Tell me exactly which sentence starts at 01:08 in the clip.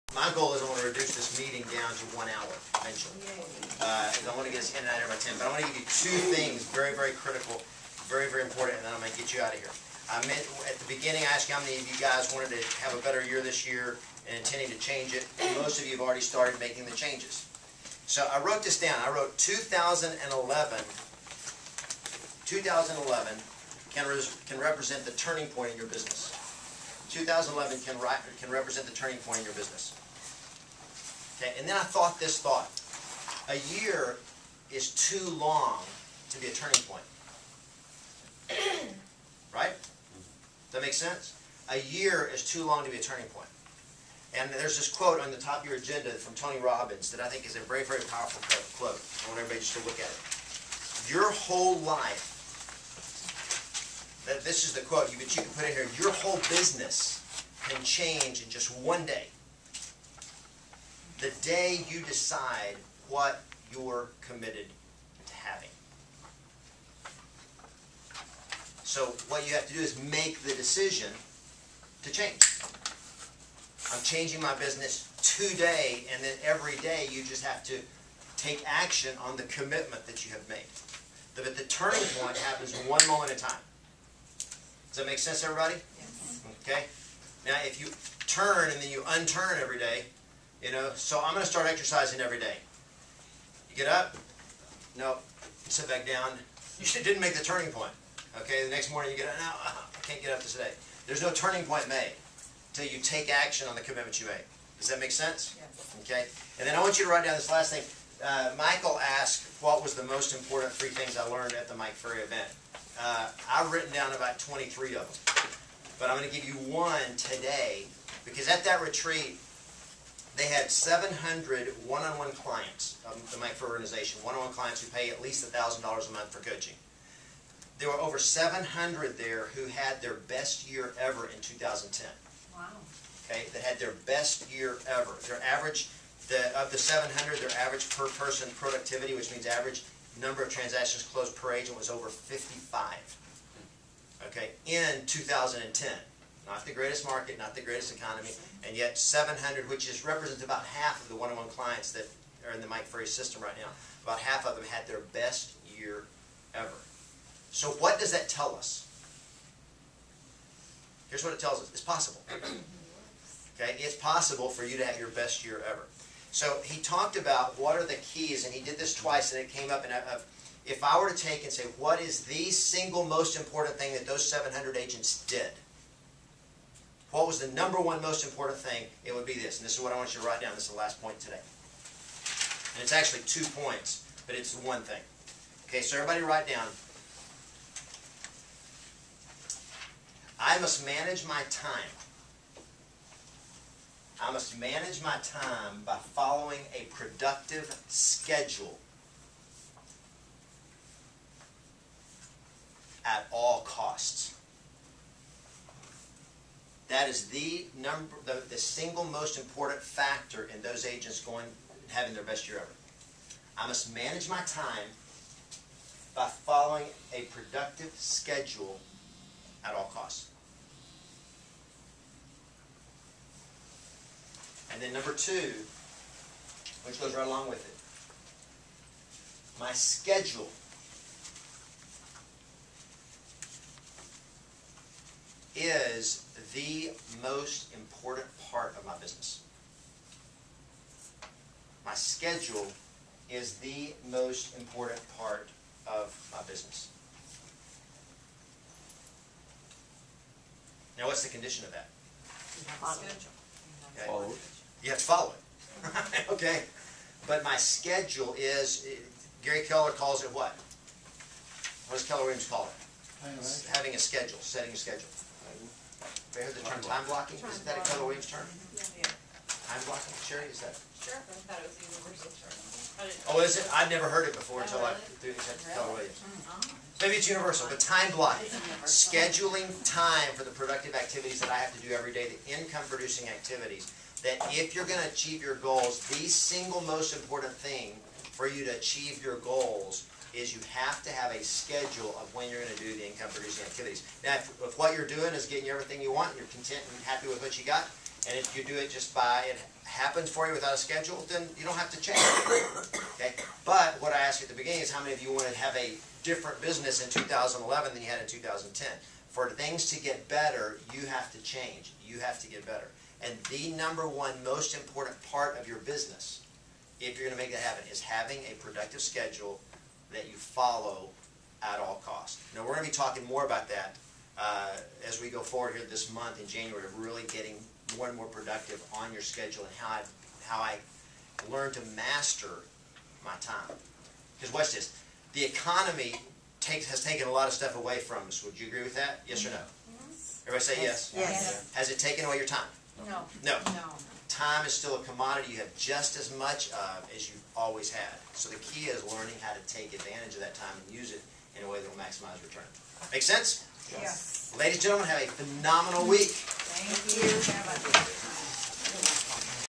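So what you have to do is make the decision to change.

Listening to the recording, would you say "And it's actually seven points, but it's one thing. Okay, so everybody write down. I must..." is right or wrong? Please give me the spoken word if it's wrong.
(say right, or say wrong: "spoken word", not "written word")
wrong: "two", not "seven".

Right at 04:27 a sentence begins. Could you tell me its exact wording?
Time Isn't that a Keller term?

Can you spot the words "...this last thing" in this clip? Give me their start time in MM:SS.
01:47.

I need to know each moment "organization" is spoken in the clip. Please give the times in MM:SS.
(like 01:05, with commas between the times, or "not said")
02:03.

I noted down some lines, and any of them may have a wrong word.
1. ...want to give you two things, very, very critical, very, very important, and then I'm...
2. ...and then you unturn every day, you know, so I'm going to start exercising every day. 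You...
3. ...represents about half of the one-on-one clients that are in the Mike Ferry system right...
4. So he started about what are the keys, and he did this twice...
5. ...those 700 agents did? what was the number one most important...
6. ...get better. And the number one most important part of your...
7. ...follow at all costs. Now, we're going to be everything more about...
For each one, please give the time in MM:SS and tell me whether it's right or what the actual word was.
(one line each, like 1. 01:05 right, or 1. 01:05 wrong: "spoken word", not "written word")
1. 00:05 right
2. 01:28 right
3. 02:30 right
4. 02:46 wrong: "talked", not "started"
5. 02:54 right
6. 05:12 right
7. 05:20 wrong: "talking", not "everything".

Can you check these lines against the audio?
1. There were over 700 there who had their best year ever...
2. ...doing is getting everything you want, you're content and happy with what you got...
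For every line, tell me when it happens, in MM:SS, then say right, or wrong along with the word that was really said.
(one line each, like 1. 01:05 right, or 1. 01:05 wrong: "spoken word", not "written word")
1. 02:07 right
2. 04:55 right.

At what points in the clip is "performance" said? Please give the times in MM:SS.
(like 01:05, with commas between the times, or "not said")
not said.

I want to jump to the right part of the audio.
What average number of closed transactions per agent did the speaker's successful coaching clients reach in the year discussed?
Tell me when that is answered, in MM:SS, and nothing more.
02:22.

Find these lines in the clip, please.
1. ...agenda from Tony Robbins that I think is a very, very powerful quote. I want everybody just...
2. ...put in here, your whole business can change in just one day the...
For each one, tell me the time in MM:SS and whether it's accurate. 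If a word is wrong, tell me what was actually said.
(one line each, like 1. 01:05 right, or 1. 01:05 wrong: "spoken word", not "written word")
1. 00:45 right
2. 00:55 right.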